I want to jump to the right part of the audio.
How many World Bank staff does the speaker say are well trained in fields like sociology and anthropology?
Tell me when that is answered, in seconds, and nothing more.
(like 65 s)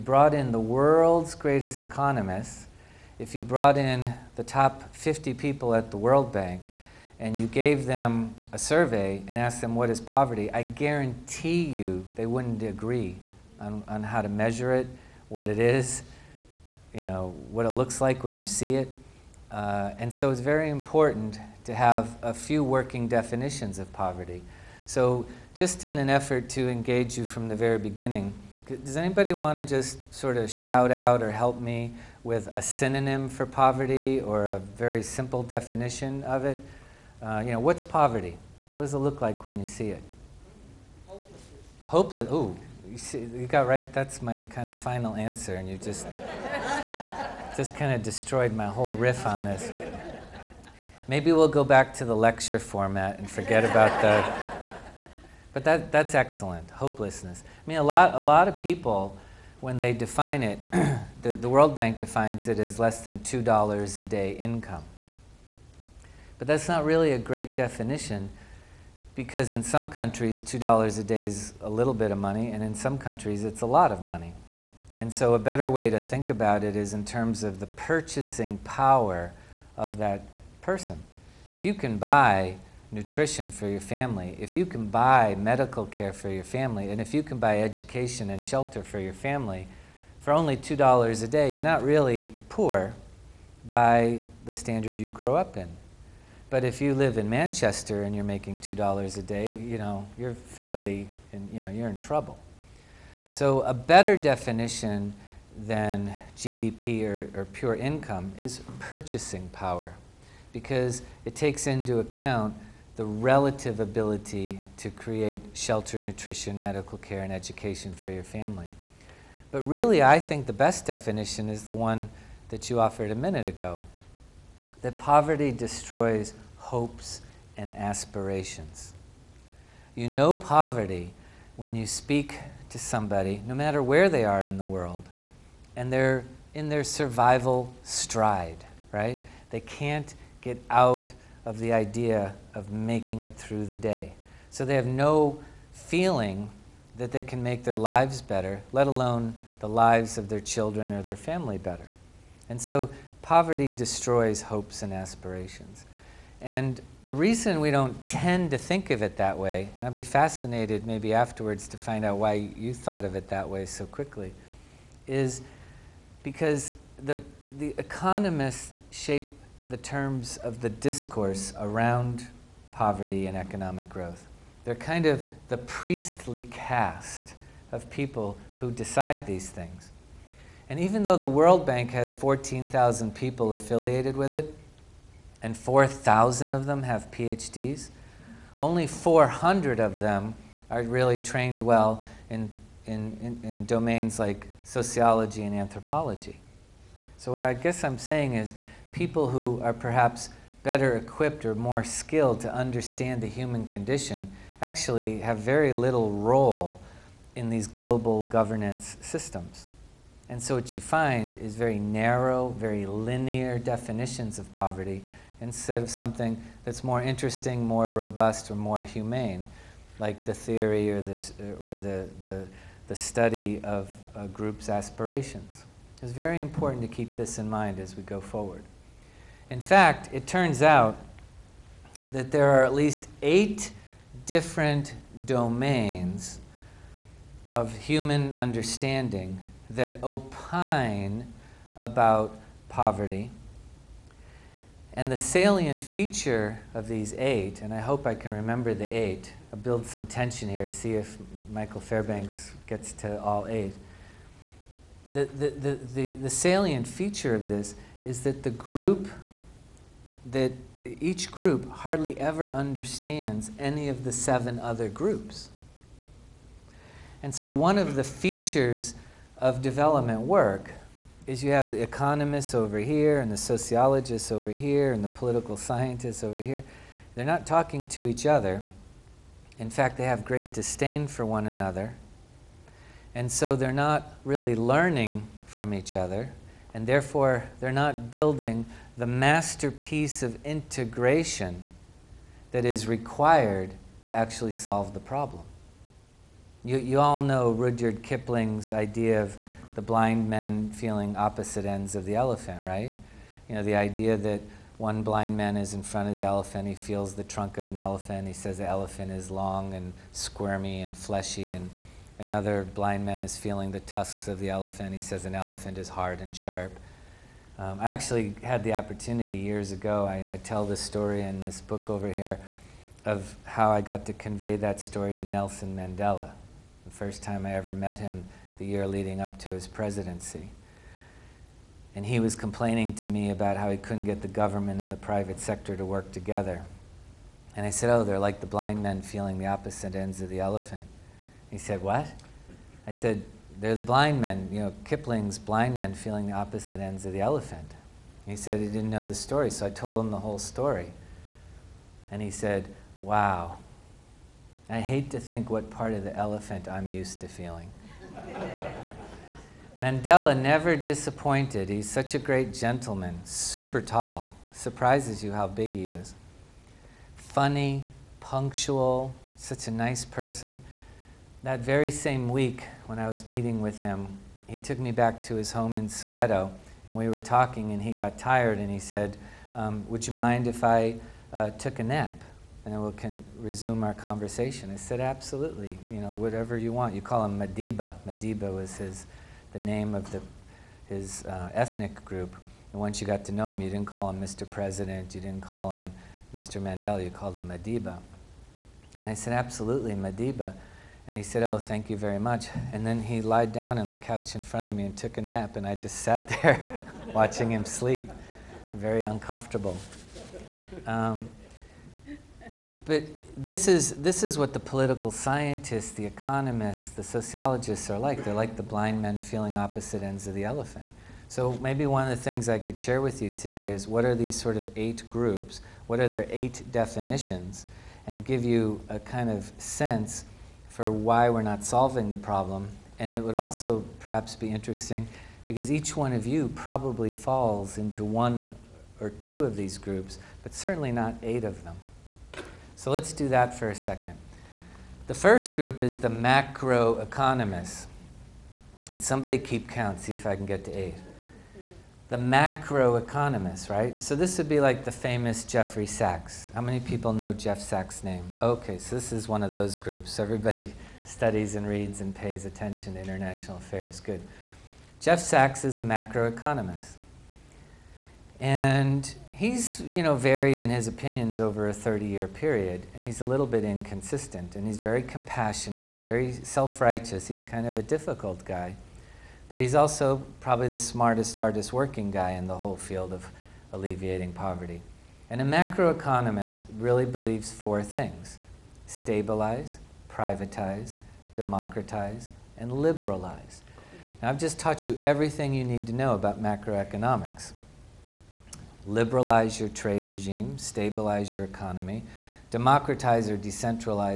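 188 s.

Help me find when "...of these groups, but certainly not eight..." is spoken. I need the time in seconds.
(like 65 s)
439 s.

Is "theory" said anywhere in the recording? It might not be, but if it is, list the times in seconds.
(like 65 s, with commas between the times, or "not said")
220 s.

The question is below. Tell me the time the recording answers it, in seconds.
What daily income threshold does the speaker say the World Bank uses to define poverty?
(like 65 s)
62 s.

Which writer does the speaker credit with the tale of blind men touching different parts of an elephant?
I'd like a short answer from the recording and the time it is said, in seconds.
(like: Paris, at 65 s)
Rudyard Kipling, at 297 s.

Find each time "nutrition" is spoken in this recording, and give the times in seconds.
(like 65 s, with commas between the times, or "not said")
82 s, 116 s.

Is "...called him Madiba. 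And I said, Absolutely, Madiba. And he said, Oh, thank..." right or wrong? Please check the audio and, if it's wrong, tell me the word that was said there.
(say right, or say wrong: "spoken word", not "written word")
right.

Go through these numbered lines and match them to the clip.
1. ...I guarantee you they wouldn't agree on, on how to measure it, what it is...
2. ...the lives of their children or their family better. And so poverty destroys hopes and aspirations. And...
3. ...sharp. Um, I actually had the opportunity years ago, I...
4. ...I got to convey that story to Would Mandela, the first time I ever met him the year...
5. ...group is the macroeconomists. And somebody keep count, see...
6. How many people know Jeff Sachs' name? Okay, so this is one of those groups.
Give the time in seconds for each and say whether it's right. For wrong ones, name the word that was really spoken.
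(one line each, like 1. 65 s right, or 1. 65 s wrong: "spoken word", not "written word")
1. 10 s right
2. 149 s right
3. 316 s right
4. 323 s wrong: "Nelson", not "Would"
5. 445 s right
6. 456 s right.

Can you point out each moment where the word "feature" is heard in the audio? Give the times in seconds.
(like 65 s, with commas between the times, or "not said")
245 s, 256 s, 268 s.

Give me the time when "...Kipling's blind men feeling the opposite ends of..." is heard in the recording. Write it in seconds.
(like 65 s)
344 s.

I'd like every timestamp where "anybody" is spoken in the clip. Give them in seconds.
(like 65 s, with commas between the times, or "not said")
28 s.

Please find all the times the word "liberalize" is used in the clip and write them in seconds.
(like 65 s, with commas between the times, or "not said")
492 s, 498 s.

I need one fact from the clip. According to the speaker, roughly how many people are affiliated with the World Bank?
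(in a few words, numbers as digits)
14,000.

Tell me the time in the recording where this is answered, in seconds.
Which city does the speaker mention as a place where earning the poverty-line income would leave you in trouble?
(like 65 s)
97 s.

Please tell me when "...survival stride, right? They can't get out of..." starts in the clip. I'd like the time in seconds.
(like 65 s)
136 s.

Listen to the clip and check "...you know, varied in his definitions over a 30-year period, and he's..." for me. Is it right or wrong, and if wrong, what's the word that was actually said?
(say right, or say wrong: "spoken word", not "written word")
wrong: "opinions", not "definitions".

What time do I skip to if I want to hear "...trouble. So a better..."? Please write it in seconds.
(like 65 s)
101 s.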